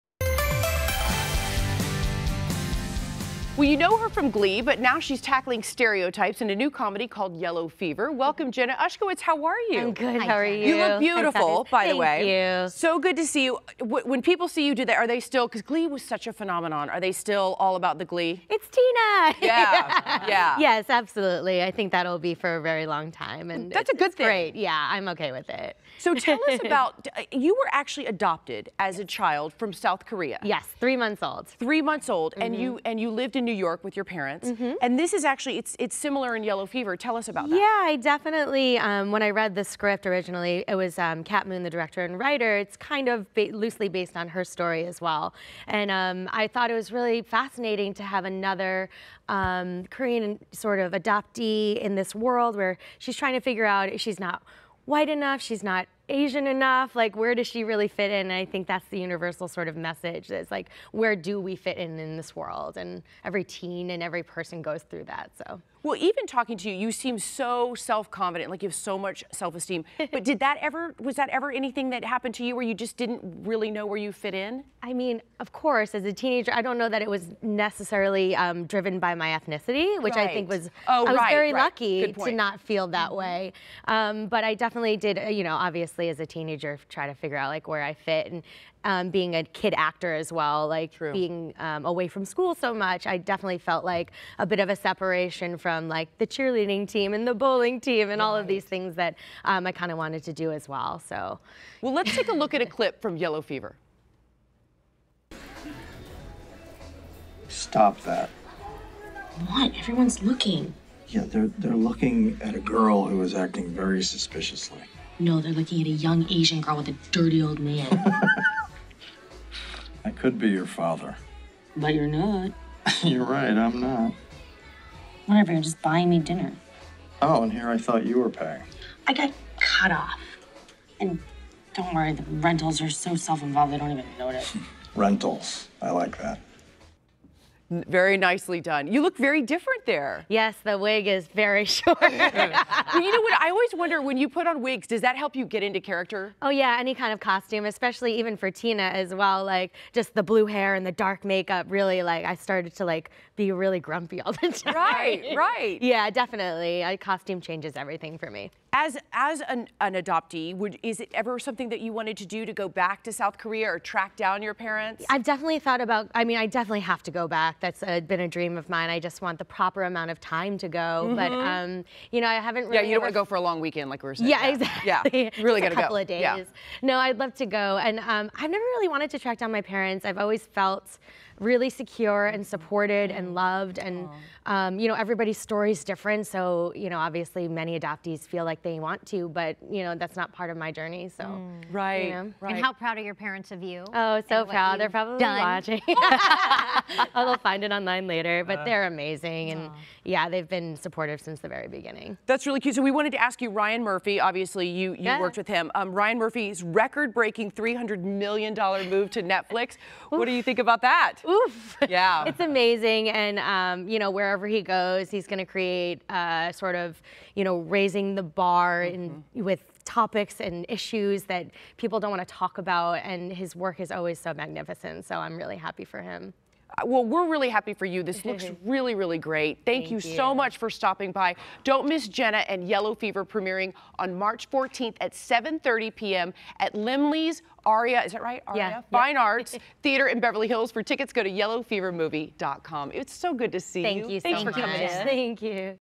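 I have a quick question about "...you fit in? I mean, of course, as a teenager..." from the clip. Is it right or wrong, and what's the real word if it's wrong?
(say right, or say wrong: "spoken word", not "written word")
right.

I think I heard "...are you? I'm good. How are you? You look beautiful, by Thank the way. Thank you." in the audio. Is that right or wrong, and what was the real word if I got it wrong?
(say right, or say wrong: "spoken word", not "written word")
right.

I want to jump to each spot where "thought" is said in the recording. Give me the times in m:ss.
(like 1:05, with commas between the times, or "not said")
0:46, 2:07, 2:45.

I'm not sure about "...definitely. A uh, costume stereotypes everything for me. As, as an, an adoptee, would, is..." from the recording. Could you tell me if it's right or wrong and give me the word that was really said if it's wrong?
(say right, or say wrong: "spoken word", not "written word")
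wrong: "changes", not "stereotypes".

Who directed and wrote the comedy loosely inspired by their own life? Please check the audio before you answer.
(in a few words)
Kat Moon.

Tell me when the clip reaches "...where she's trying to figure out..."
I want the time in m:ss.
0:52.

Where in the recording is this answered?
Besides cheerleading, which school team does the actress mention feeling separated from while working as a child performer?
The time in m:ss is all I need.
1:37.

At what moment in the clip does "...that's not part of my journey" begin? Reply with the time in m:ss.
3:09.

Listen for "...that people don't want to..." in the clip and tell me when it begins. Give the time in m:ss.
3:41.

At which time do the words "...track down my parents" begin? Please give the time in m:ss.
2:59.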